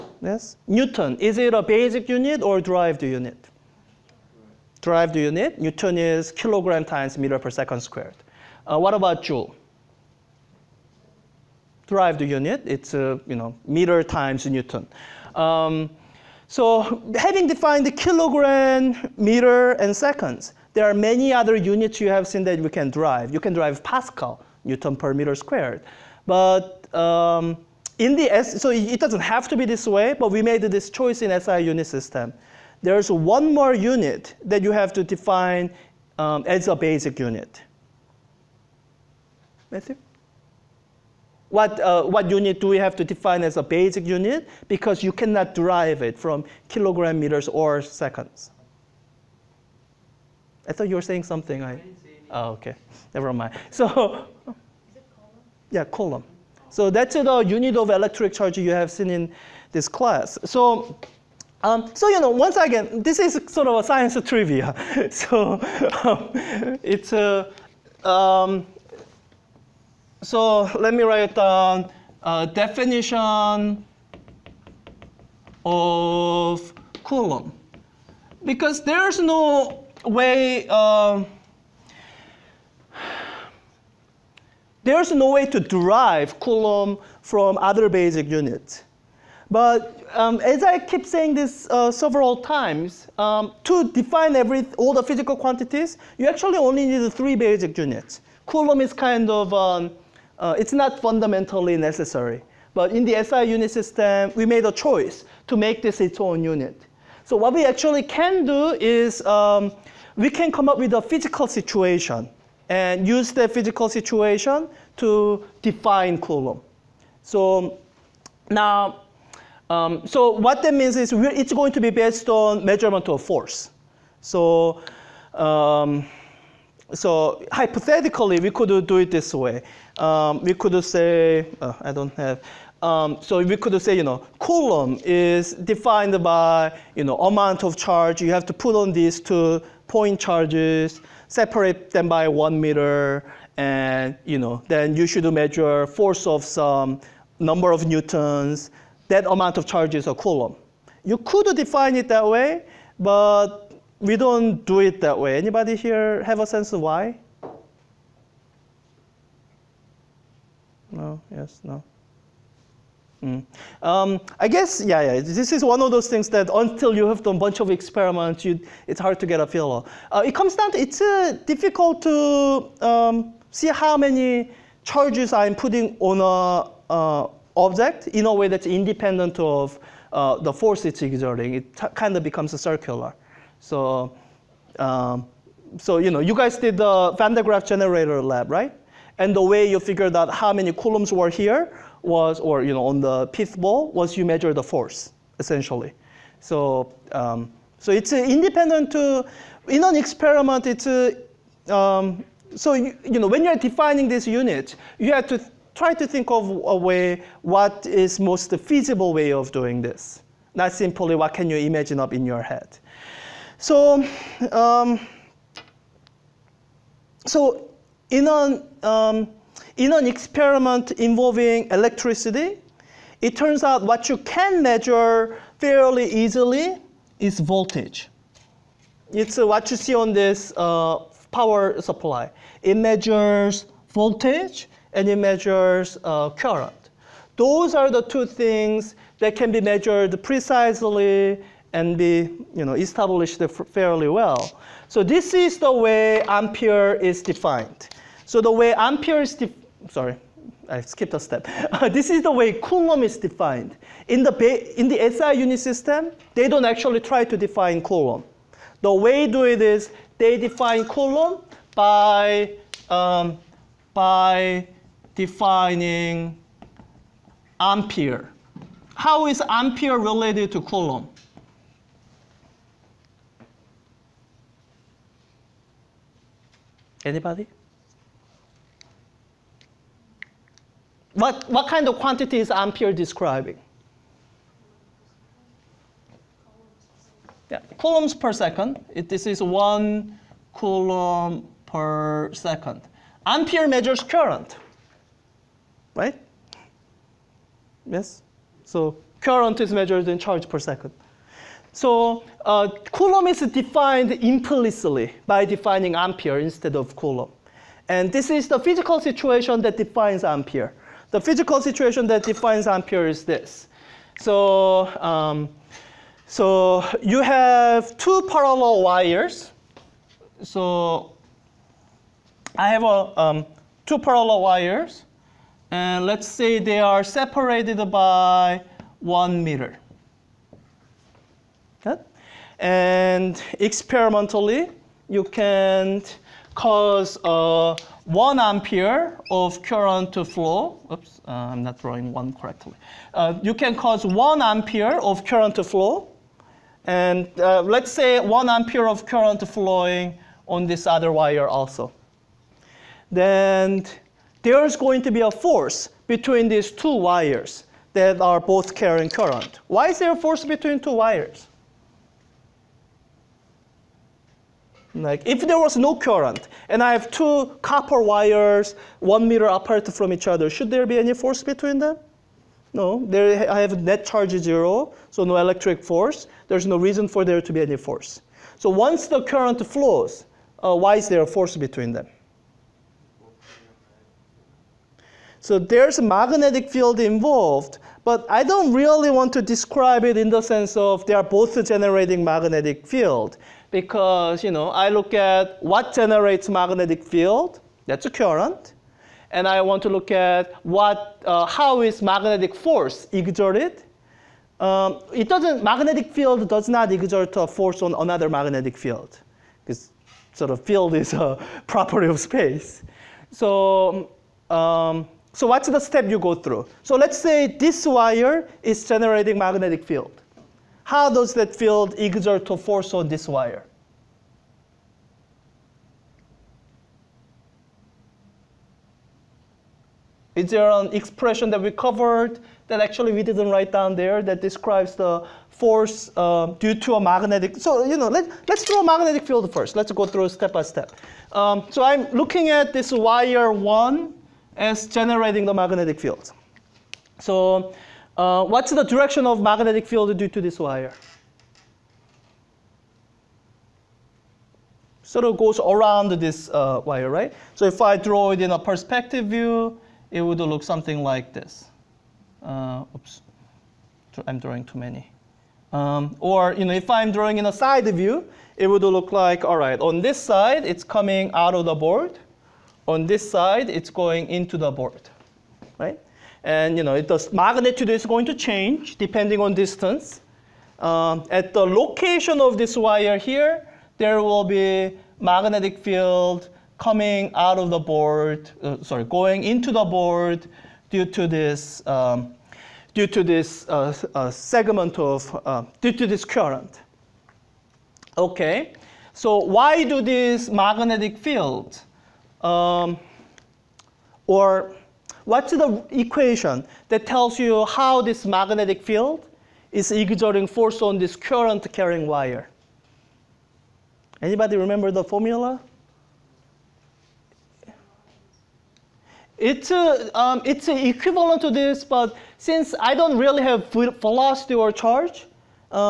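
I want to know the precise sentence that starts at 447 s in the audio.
So uh, what's the direction of magnetic field due to this wire?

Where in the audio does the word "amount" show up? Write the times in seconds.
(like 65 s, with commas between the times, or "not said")
137 s, 149 s.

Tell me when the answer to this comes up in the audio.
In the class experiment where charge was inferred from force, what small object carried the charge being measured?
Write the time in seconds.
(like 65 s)
193 s.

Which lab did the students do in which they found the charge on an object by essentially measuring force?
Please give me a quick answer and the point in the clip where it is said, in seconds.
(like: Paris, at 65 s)
Van de Graaff generator lab, at 187 s.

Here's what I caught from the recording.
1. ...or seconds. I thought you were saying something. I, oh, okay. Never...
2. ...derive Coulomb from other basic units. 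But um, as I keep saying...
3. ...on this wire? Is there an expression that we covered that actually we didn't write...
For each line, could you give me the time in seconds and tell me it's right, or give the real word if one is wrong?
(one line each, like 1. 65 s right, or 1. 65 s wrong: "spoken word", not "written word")
1. 47 s right
2. 85 s right
3. 422 s right.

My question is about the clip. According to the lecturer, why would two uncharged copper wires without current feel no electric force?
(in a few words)
net charge zero.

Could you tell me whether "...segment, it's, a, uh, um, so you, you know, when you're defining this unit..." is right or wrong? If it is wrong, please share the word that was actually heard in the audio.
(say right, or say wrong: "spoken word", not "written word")
wrong: "experiment", not "segment".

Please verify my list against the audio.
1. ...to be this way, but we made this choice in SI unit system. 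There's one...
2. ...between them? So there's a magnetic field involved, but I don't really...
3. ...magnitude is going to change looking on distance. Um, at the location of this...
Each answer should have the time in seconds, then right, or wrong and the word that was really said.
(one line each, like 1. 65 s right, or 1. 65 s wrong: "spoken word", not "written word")
1. 29 s right
2. 381 s right
3. 477 s wrong: "depending", not "looking".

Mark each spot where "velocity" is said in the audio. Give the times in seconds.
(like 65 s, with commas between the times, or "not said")
523 s.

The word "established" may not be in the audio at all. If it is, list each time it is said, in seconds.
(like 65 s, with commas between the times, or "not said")
242 s.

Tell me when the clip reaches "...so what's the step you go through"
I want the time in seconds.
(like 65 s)
415 s.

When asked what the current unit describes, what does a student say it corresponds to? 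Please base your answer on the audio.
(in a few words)
coulombs per second.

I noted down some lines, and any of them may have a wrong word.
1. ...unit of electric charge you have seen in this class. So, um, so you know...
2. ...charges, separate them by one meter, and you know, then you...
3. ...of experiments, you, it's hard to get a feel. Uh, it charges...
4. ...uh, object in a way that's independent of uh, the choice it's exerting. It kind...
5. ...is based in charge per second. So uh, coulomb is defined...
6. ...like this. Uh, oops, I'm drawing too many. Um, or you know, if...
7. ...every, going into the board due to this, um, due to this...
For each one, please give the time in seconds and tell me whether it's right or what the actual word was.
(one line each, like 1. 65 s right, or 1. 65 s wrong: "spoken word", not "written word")
1. 57 s right
2. 140 s right
3. 167 s wrong: "comes", not "charges"
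4. 176 s wrong: "force", not "choice"
5. 299 s wrong: "measured", not "based"
6. 461 s right
7. 488 s wrong: "sorry", not "every".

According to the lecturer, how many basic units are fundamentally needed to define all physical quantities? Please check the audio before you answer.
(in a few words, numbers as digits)
3.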